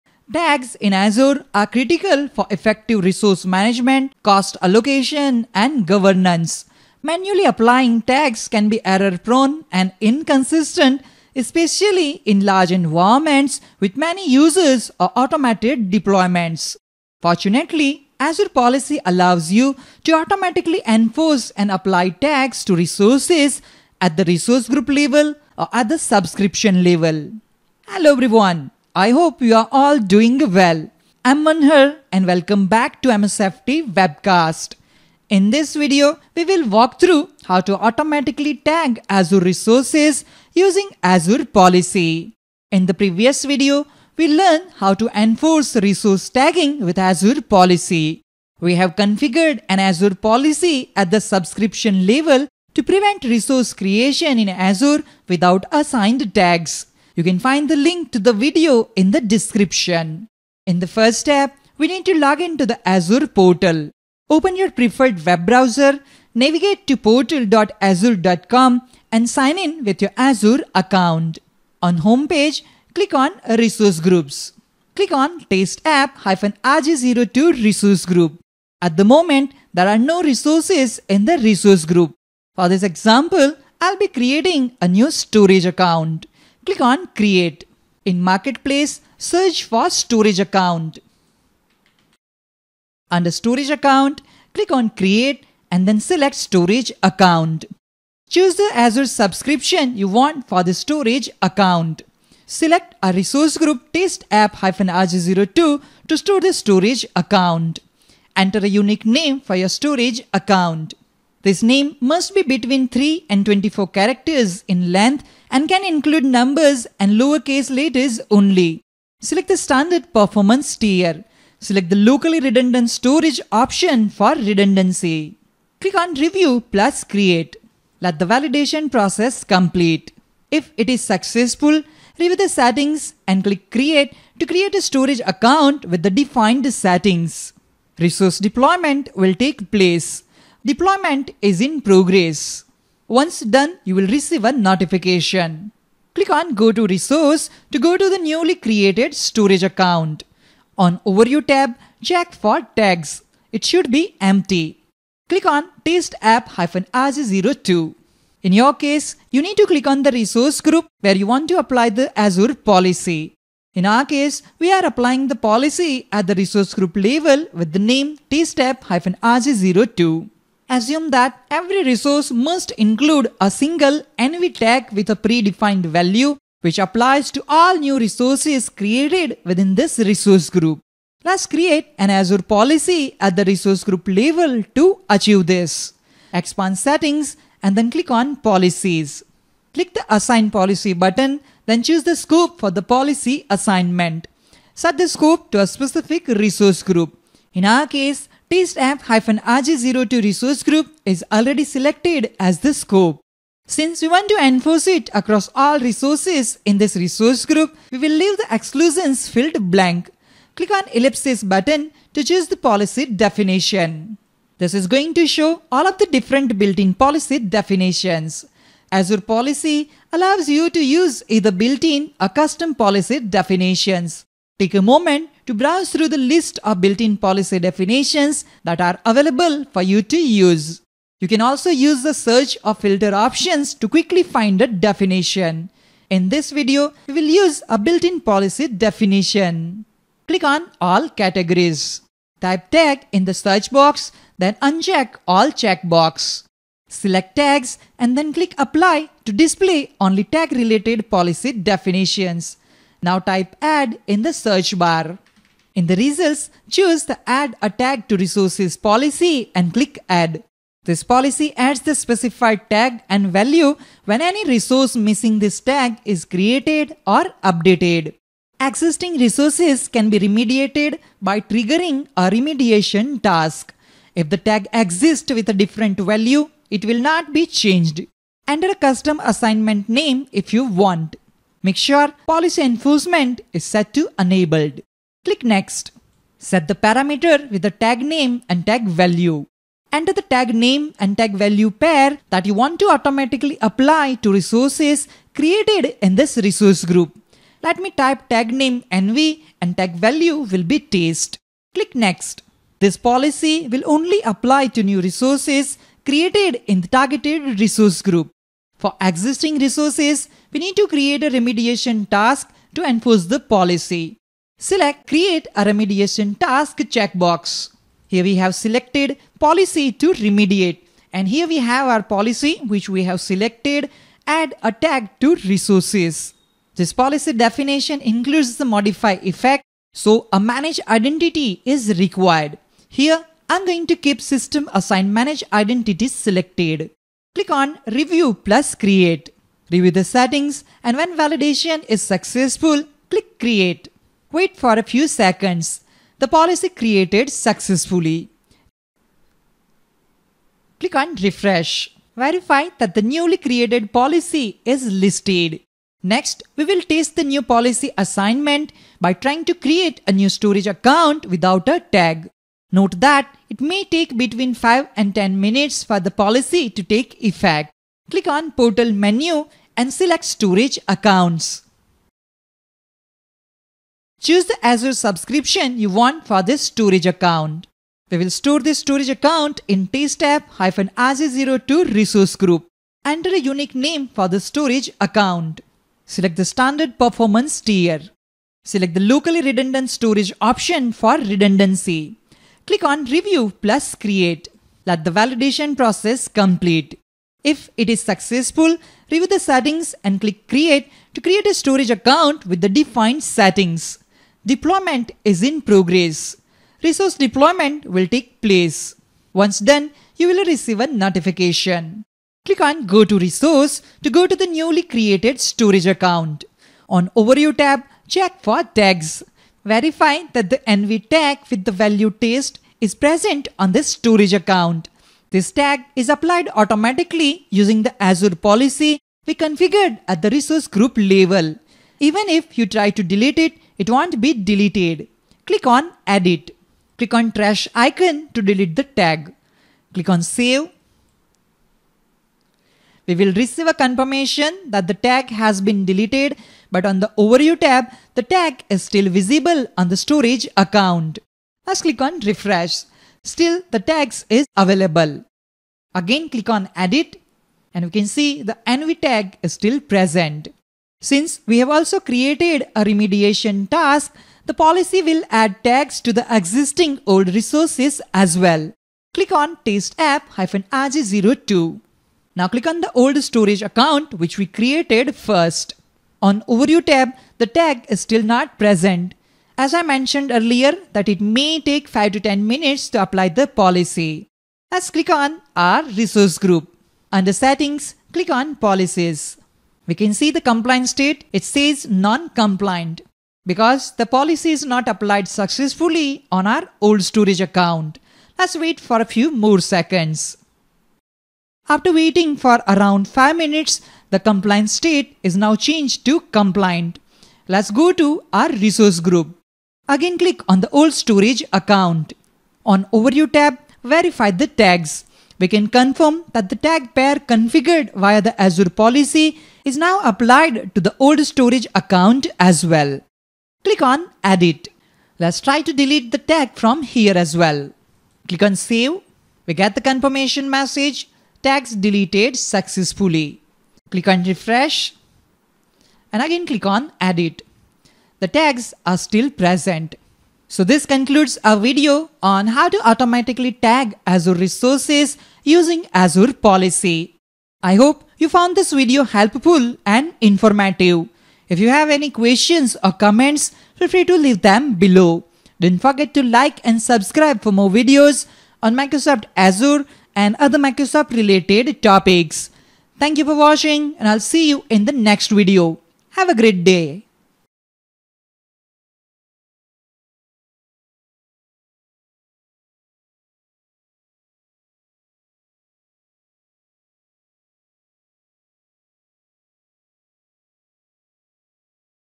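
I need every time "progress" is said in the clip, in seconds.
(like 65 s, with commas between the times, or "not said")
141 s, 405 s.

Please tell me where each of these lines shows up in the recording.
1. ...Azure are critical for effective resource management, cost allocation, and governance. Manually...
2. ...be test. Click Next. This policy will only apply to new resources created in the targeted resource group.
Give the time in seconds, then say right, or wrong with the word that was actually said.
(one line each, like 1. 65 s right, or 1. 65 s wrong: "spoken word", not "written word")
1. 0 s right
2. 300 s right.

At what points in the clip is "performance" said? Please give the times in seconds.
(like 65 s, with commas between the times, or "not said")
120 s, 386 s.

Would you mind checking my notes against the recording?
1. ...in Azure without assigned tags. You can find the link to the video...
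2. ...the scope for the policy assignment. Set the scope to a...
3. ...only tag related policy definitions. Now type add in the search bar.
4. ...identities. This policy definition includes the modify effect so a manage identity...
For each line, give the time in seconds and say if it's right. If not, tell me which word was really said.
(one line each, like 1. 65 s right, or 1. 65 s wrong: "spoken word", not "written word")
1. 54 s right
2. 192 s right
3. 249 s right
4. 325 s wrong: "resources", not "identities".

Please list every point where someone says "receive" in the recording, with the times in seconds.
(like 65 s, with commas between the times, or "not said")
144 s, 410 s, 443 s.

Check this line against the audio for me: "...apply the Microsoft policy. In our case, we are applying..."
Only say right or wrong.
wrong.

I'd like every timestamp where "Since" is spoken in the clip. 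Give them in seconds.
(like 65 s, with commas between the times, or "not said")
203 s, 461 s.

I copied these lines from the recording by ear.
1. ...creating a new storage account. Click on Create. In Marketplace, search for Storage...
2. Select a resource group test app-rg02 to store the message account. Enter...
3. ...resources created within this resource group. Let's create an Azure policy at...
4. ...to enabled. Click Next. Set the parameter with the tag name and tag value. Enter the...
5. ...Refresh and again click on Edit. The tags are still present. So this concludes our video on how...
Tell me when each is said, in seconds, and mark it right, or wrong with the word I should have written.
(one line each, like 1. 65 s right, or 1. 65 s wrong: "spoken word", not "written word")
1. 84 s right
2. 102 s wrong: "storage", not "message"
3. 177 s right
4. 283 s right
5. 534 s right.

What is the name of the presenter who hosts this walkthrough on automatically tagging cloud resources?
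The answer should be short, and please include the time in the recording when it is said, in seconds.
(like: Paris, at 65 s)
Manhar, at 31 s.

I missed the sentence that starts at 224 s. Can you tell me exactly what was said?
Take a moment to browse through the list of built-in policy definitions that are available for you to use.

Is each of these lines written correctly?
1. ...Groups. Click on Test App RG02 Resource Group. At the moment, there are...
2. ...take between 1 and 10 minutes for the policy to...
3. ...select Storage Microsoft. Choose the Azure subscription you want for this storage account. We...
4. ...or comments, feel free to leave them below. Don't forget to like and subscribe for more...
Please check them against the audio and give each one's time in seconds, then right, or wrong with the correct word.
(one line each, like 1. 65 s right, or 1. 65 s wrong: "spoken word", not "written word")
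1. 73 s right
2. 363 s wrong: "5", not "1"
3. 369 s wrong: "Accounts", not "Microsoft"
4. 552 s right.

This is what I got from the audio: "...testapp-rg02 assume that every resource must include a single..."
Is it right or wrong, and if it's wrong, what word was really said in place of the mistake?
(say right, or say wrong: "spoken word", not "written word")
right.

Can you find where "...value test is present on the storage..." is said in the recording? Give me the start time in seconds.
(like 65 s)
421 s.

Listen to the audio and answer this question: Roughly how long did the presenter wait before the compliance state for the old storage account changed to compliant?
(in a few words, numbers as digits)
5 minutes.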